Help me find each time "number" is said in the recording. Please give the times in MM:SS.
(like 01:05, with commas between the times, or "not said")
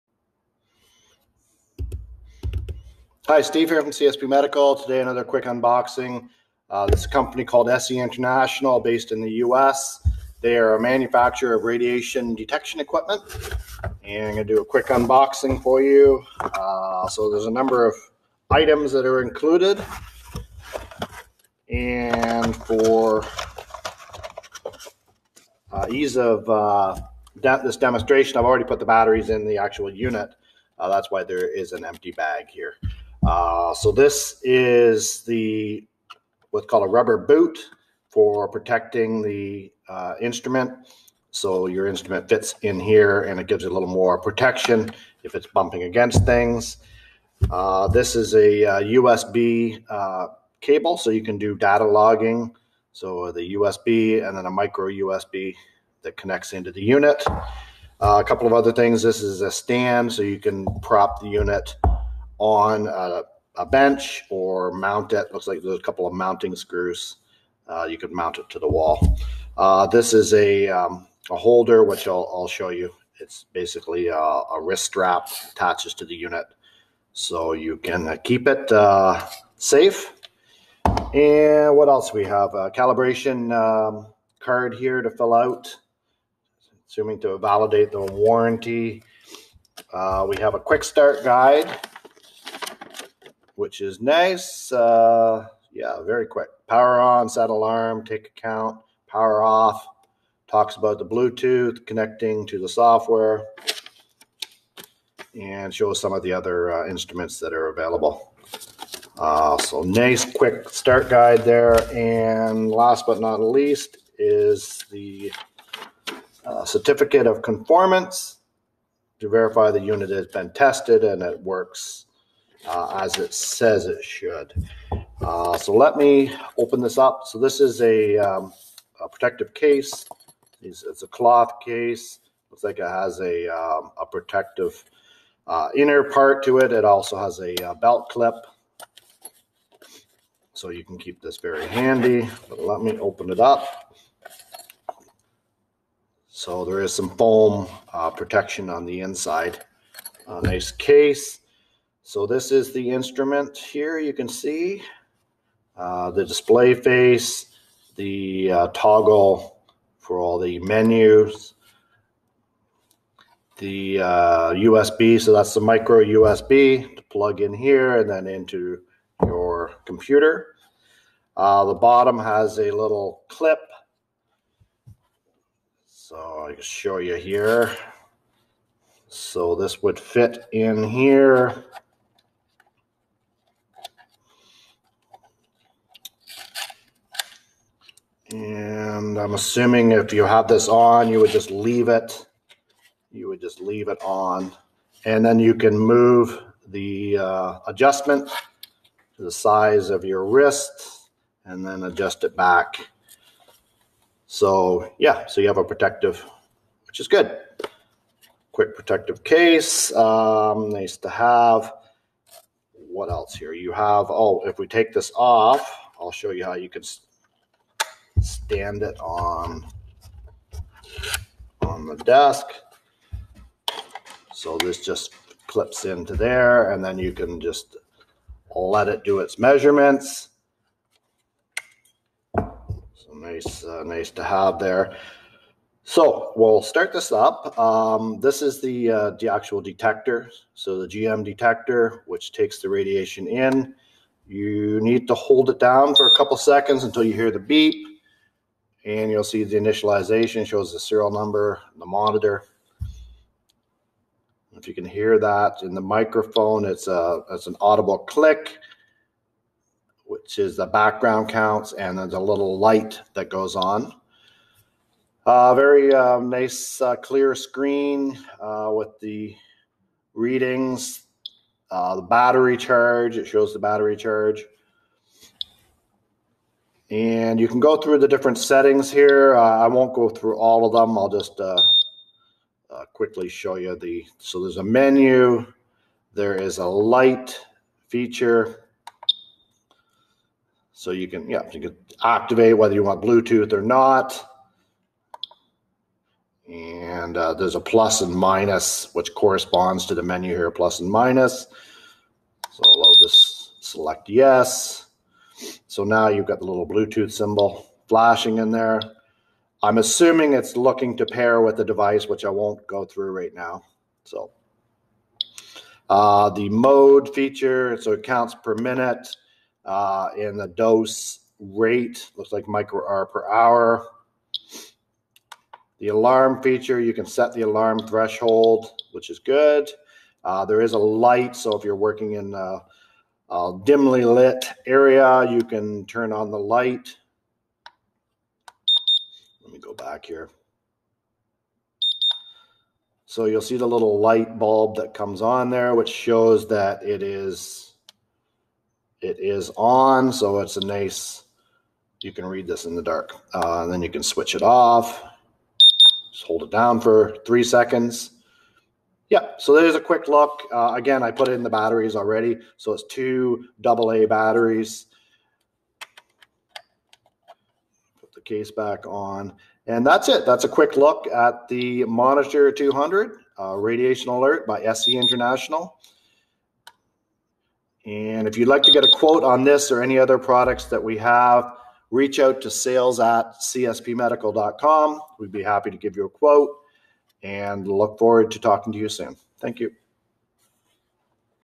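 00:17, 04:11.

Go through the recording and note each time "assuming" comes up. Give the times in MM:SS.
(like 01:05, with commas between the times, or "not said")
01:26, 03:09, 05:09.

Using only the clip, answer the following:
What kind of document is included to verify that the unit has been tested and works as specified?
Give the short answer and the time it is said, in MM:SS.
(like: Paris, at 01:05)
Certificate of conformance, at 01:56.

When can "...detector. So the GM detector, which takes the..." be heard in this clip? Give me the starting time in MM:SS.
03:59.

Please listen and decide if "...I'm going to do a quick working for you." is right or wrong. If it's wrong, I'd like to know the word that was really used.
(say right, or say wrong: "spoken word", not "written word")
wrong: "unboxing", not "working".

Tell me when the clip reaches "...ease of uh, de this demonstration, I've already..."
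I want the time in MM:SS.
00:25.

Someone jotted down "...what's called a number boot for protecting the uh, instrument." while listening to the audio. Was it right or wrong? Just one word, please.
wrong.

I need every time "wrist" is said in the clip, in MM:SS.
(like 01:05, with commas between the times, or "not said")
01:14, 03:20.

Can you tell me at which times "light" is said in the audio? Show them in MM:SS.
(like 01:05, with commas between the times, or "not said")
04:22, 04:46, 05:30, 05:36, 05:43.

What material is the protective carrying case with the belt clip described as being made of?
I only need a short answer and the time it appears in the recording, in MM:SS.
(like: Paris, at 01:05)
Cloth, at 02:11.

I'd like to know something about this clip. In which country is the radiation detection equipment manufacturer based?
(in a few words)
US.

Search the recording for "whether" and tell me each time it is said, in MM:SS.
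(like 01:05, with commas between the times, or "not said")
04:52.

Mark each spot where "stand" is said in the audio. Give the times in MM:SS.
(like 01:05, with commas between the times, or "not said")
00:59, 03:38.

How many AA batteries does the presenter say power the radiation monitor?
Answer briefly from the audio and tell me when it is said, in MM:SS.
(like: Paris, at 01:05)
2, at 06:02.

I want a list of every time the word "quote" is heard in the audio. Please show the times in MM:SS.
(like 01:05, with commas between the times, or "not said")
06:18, 06:26.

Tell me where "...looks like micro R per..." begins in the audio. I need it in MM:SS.
05:22.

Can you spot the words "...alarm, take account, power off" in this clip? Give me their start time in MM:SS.
01:37.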